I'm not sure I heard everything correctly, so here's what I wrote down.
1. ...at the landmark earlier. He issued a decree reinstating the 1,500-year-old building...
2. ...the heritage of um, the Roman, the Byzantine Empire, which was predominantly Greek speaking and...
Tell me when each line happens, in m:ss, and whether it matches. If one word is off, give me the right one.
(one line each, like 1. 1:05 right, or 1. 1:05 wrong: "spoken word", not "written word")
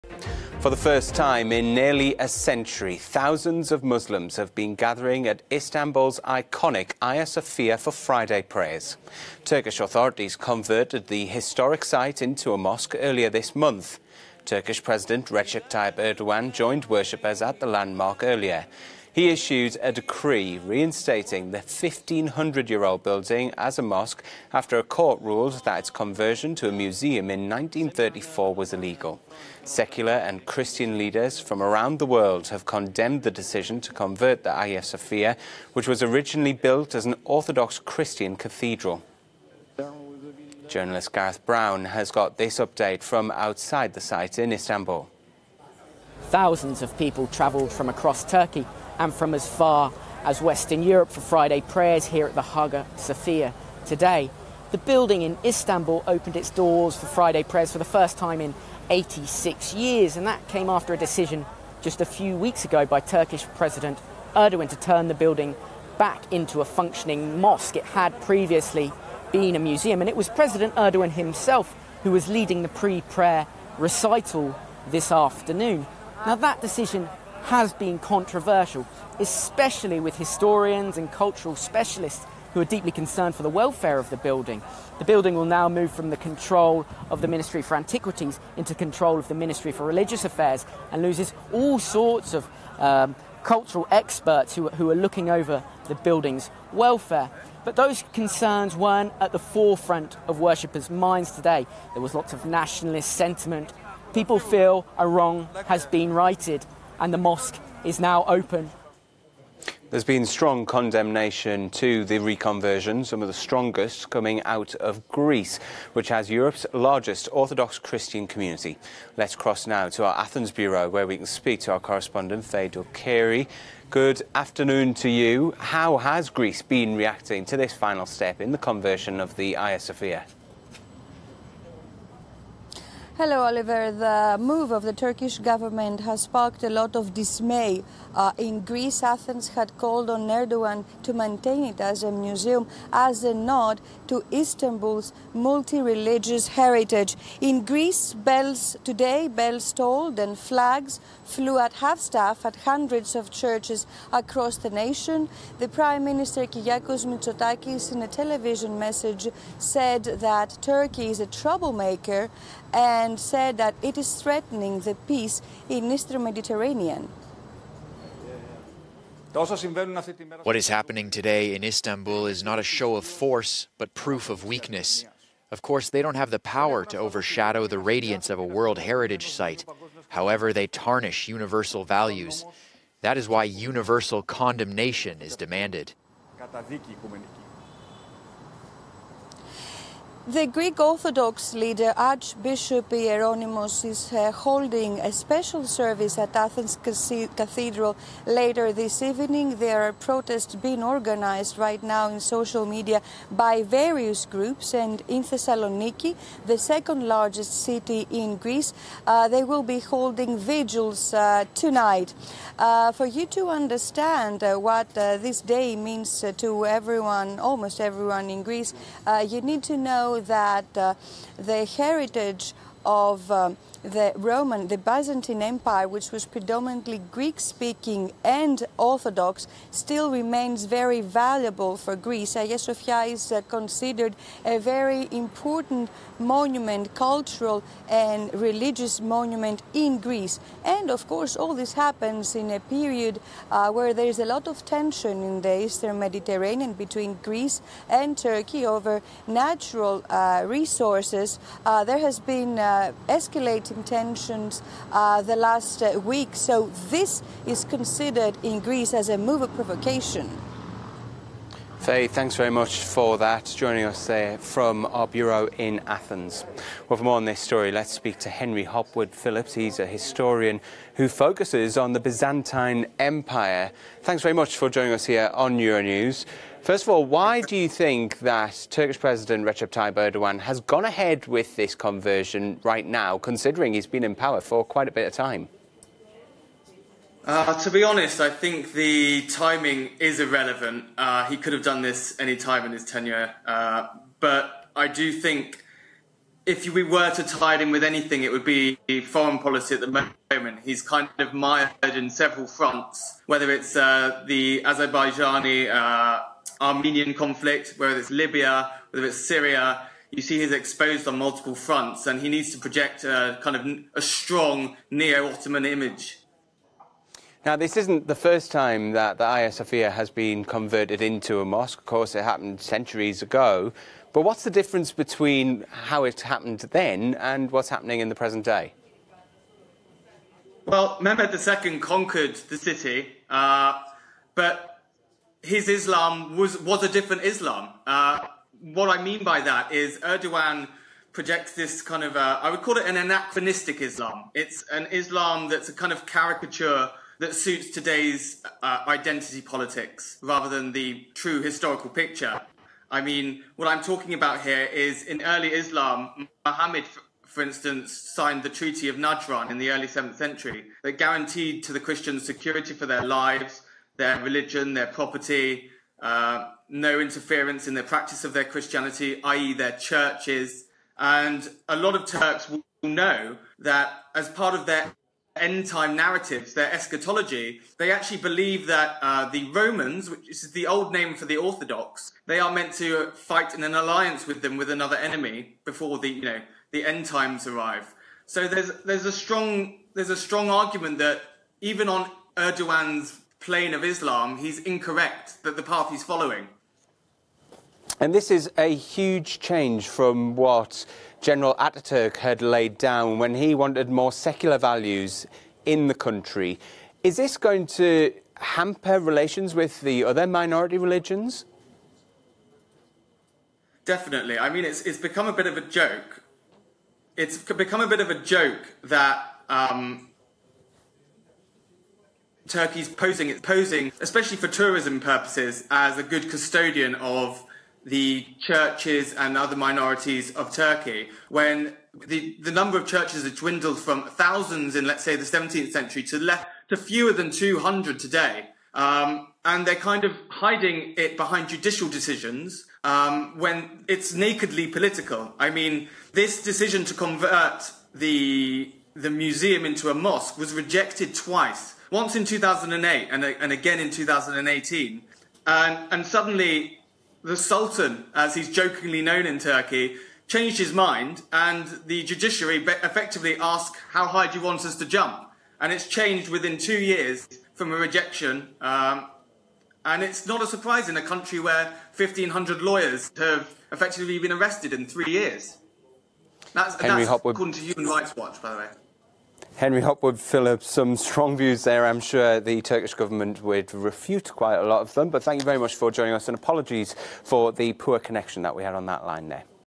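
1. 0:17 right
2. 3:41 right.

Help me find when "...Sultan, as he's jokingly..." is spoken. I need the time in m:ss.
7:37.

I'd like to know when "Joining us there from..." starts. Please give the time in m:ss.
4:23.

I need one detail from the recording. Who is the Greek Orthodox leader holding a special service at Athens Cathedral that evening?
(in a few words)
Archbishop Hieronymus.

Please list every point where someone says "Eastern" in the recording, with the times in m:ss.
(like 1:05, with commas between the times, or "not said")
2:45, 4:05.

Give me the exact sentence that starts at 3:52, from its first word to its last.
Hagia uh, Sophia is uh, considered a very important monument, cultural and religious monument in Greece.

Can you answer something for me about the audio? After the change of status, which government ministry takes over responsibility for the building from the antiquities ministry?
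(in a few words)
Ministry for Religious Affairs.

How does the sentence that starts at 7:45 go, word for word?
And it's changed within two years from a rejection.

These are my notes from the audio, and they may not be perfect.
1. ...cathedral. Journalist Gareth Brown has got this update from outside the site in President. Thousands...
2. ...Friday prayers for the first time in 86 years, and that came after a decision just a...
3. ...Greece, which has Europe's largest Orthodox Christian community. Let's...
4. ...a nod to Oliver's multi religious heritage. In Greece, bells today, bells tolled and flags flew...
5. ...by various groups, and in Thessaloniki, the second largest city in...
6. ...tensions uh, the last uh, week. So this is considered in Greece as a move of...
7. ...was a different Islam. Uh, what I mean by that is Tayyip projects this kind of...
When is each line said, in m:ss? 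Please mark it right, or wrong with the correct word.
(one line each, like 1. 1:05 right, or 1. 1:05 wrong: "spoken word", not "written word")
1. 0:38 wrong: "Istanbul", not "President"
2. 0:57 right
3. 1:55 right
4. 2:23 wrong: "Istanbul", not "Oliver"
5. 3:23 right
6. 4:13 right
7. 5:36 wrong: "Erdogan", not "Tayyip".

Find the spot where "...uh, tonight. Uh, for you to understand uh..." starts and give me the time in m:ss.
3:31.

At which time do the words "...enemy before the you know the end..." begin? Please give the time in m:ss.
6:24.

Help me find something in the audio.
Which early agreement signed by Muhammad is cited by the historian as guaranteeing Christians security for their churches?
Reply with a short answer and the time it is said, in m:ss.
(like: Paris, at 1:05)
Treaty of Najran, at 5:58.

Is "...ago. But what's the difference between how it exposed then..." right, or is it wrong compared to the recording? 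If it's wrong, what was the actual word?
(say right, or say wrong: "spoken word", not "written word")
wrong: "happened", not "exposed".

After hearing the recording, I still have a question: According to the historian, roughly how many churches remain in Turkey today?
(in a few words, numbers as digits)
fewer than 200.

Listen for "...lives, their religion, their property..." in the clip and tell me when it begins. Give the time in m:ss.
6:03.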